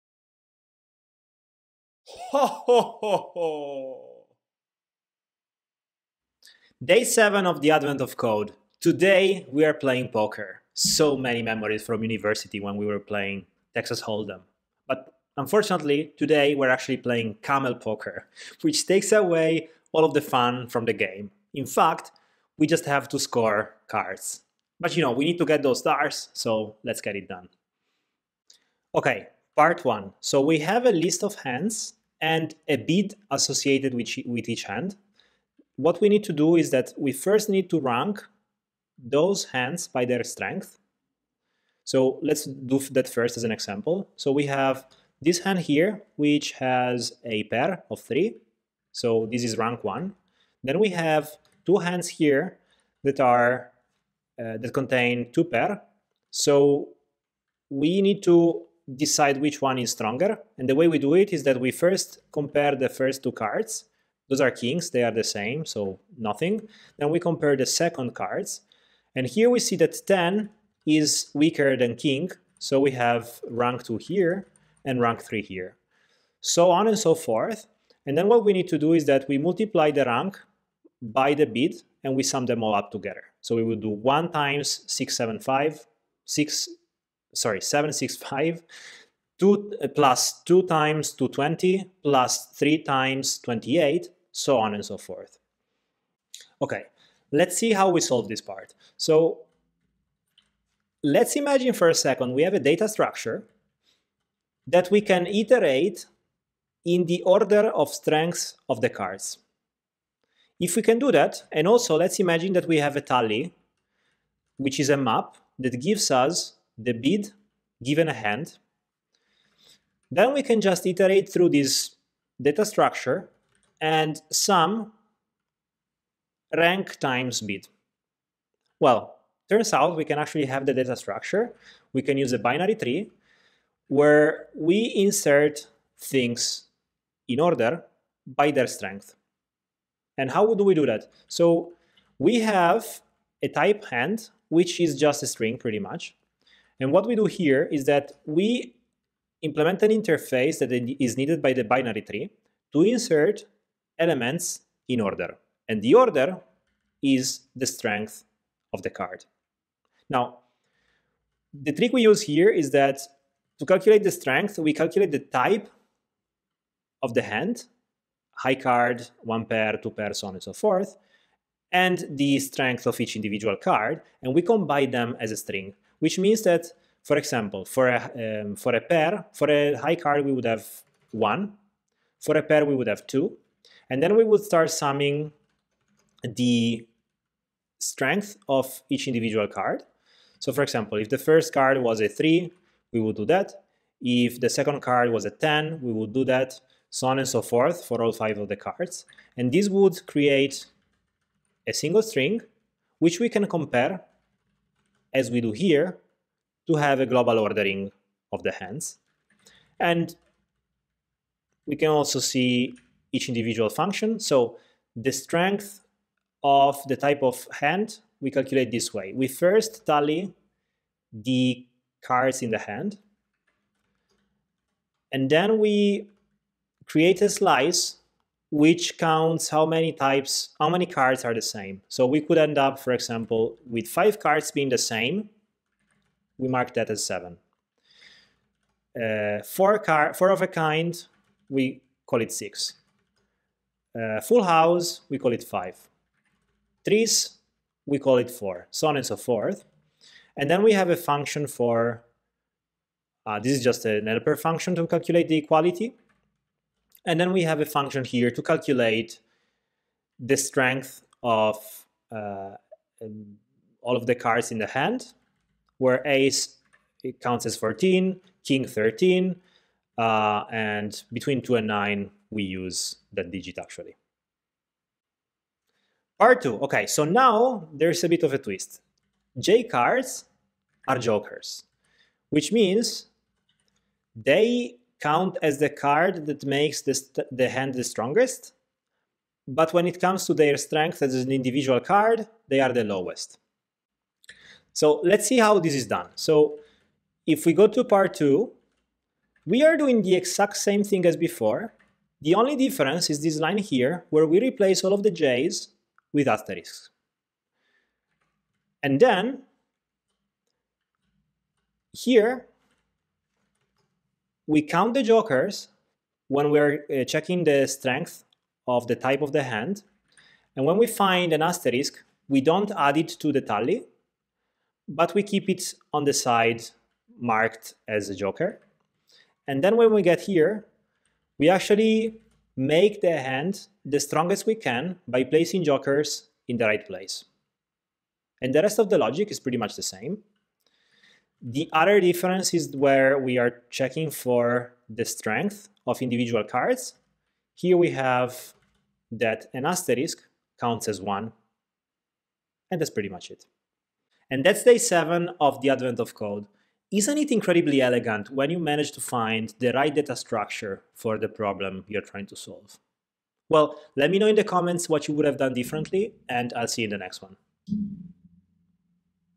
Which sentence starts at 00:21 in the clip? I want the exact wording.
In fact, we just have to score cards.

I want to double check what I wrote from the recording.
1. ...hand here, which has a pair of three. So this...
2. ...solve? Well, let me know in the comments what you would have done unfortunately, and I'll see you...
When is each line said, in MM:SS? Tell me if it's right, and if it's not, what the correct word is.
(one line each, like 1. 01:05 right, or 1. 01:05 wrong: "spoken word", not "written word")
1. 00:45 right
2. 06:02 wrong: "differently", not "unfortunately".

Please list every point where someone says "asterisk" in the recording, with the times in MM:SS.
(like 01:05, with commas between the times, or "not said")
05:06, 05:21, 05:49.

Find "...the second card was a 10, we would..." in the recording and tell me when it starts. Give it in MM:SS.
03:14.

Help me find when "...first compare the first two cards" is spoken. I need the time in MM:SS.
01:01.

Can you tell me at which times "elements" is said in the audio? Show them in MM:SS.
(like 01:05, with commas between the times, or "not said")
02:33.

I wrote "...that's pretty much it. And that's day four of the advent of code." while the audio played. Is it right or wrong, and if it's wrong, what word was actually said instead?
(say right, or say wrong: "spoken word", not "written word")
wrong: "seven", not "four".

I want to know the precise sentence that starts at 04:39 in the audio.
J cards are jokers, which means they count as the card that makes the, the hand the strongest.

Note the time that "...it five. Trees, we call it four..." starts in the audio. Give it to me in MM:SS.
04:05.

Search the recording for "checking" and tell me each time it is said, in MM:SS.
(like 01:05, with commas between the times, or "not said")
05:17, 05:43.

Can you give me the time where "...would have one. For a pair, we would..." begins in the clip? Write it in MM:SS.
03:00.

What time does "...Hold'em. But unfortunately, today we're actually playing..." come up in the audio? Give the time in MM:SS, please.
00:14.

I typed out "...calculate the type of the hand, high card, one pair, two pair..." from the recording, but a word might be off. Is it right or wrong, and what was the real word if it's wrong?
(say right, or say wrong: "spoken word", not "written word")
right.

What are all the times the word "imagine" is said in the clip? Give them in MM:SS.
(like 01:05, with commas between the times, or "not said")
01:41, 01:52.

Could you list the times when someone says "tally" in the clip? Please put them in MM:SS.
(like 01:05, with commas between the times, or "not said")
01:53, 03:39, 05:23.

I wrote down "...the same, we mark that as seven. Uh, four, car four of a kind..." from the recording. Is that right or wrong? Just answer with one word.
right.